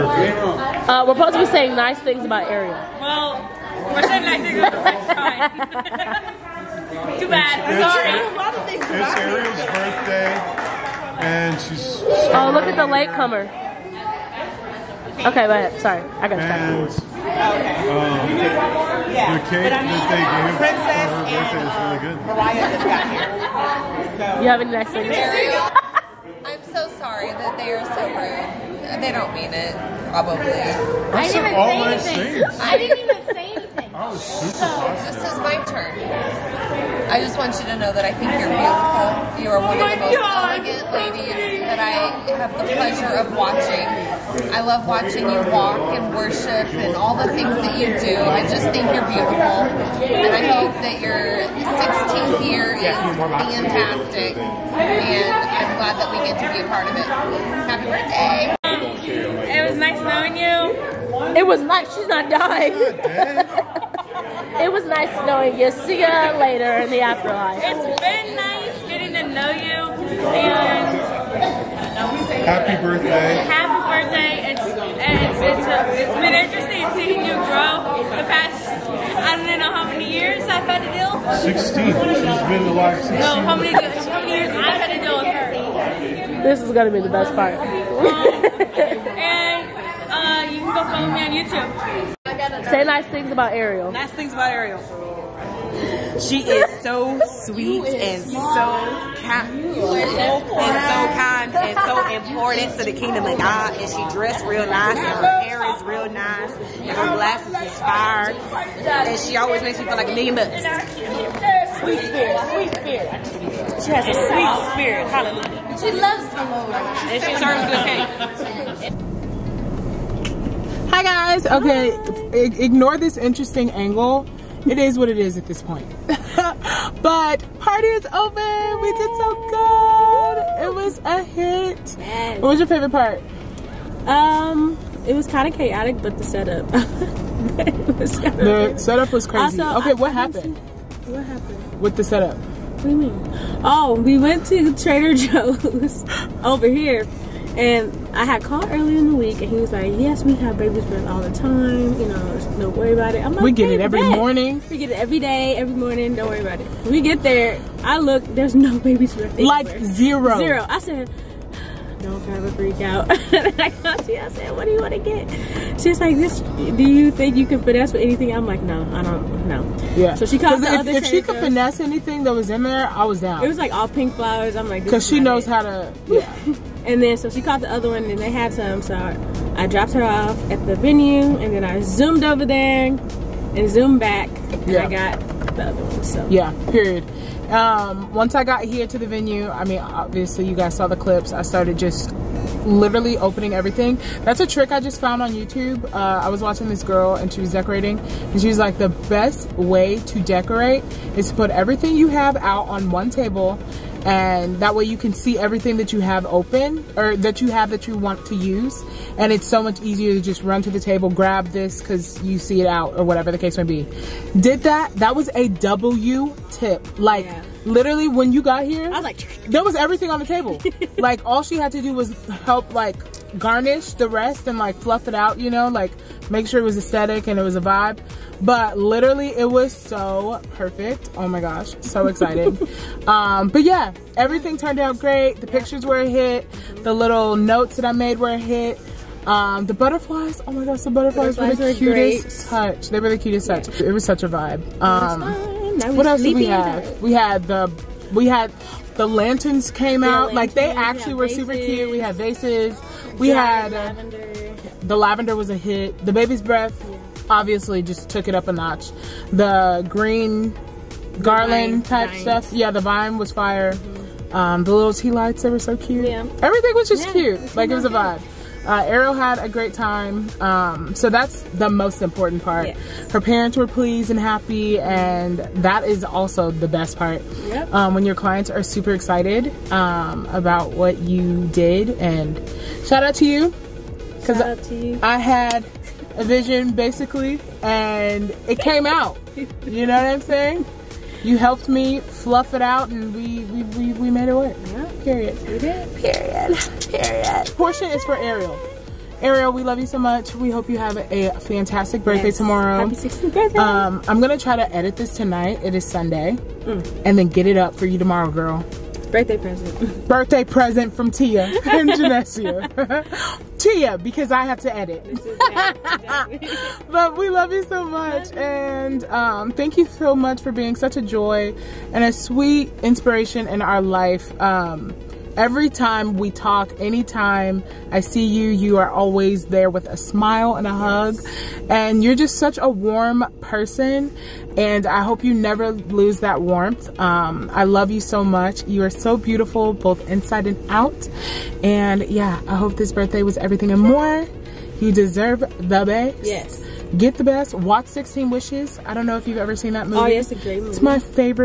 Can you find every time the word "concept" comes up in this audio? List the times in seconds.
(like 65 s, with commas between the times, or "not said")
not said.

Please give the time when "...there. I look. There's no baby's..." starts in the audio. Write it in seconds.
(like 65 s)
157 s.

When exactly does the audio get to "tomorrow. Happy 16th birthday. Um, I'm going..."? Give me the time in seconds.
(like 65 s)
302 s.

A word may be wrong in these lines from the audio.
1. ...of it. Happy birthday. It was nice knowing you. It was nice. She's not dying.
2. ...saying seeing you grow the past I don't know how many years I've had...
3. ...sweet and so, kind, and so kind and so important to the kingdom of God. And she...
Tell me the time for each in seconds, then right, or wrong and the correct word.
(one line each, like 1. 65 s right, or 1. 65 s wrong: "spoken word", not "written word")
1. 56 s right
2. 76 s wrong: "interesting", not "saying"
3. 97 s right.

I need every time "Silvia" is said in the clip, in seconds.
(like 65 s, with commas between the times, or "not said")
not said.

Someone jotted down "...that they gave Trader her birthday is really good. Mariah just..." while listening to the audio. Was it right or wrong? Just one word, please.
wrong.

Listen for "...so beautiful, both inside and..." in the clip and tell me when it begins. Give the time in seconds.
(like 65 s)
338 s.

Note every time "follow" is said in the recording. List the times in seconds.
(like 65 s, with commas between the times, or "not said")
90 s.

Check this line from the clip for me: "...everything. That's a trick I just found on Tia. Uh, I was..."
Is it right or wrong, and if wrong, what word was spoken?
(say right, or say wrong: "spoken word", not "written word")
wrong: "YouTube", not "Tia".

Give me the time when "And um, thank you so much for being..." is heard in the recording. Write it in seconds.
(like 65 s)
318 s.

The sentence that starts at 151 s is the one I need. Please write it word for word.
You know, don't worry about it." I'm like, "We get it every morning.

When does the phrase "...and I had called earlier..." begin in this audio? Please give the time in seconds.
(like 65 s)
147 s.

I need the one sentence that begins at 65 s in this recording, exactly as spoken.
See ya later in the afterlife.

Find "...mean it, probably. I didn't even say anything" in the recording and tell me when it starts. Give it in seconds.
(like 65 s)
29 s.